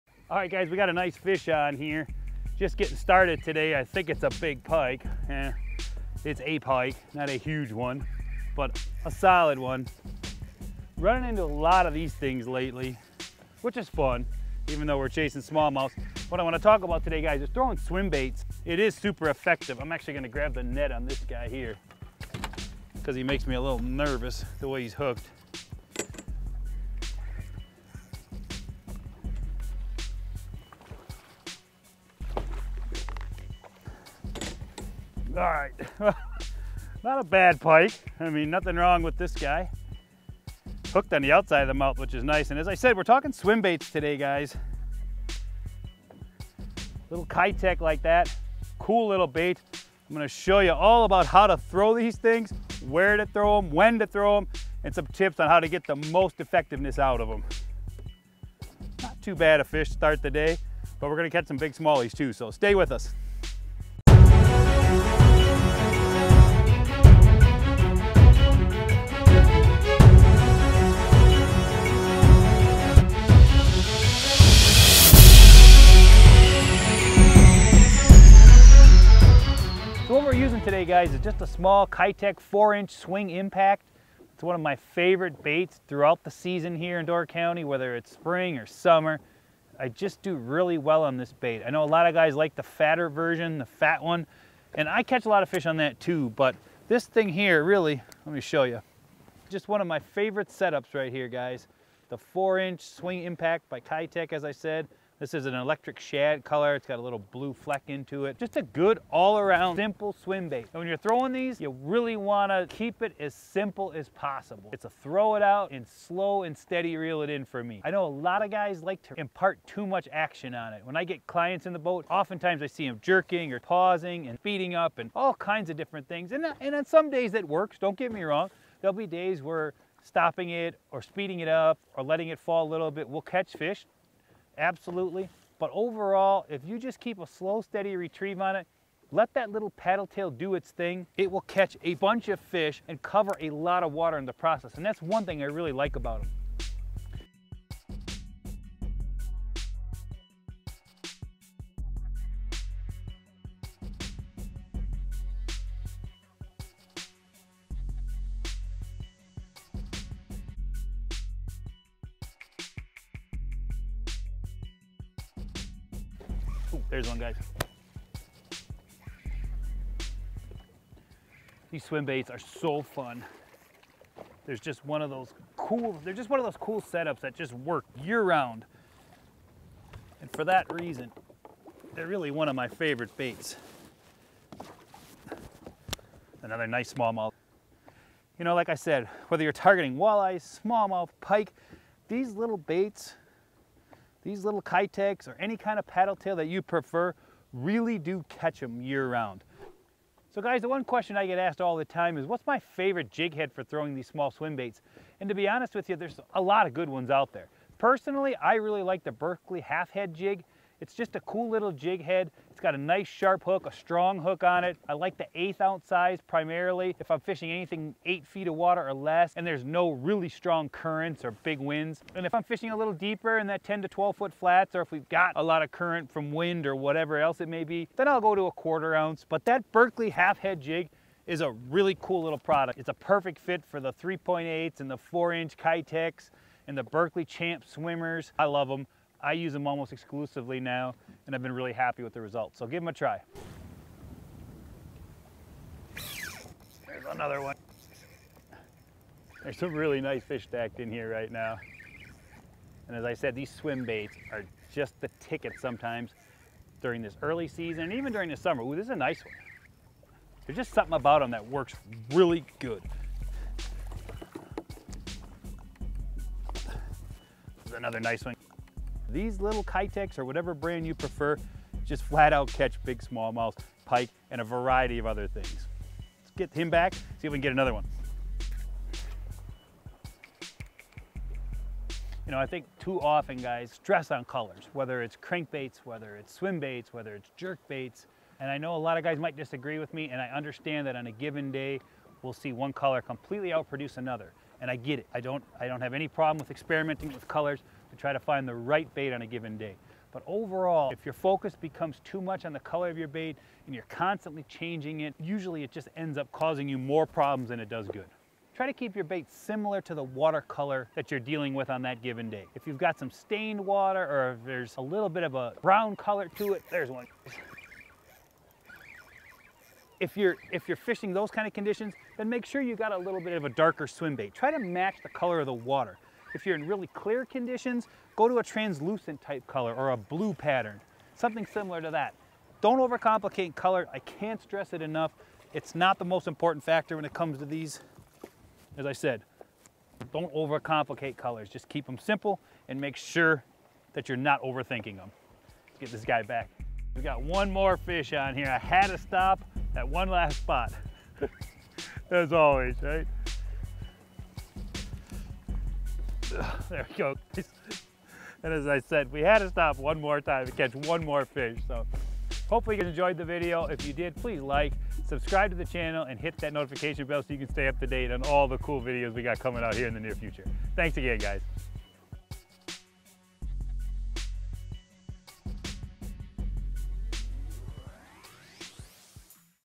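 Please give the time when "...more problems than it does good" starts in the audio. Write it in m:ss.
5:06.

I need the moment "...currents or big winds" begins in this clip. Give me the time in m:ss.
3:40.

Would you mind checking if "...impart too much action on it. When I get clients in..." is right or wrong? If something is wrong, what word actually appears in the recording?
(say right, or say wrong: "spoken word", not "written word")
right.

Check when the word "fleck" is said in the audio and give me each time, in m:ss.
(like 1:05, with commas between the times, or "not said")
1:47.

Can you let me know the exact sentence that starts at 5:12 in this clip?
If you've got some stained water or if there's a little bit of a brown color to it, there's one.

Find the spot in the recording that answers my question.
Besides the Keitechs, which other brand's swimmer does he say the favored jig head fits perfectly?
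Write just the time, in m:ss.
3:56.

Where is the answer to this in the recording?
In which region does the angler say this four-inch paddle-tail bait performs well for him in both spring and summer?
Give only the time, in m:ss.
1:27.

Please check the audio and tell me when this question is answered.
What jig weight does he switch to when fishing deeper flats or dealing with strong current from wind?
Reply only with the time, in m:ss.
3:48.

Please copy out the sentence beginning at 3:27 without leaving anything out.
Personally, I really like the Berkley half head jig.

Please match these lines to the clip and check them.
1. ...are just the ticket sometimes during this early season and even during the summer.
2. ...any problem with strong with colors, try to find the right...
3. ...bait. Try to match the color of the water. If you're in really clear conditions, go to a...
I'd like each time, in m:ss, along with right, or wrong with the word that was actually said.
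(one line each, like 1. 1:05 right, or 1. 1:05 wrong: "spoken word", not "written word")
1. 4:14 right
2. 4:55 wrong: "experimenting", not "strong"
3. 5:24 right.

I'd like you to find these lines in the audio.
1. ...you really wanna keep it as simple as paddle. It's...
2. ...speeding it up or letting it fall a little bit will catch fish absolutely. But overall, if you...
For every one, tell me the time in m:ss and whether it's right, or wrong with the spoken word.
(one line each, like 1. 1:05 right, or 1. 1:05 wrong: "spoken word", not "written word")
1. 1:51 wrong: "possible", not "paddle"
2. 2:11 right.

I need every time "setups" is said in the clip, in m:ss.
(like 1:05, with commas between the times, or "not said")
1:40, 2:56.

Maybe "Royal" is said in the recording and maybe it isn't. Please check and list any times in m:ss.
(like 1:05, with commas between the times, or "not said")
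not said.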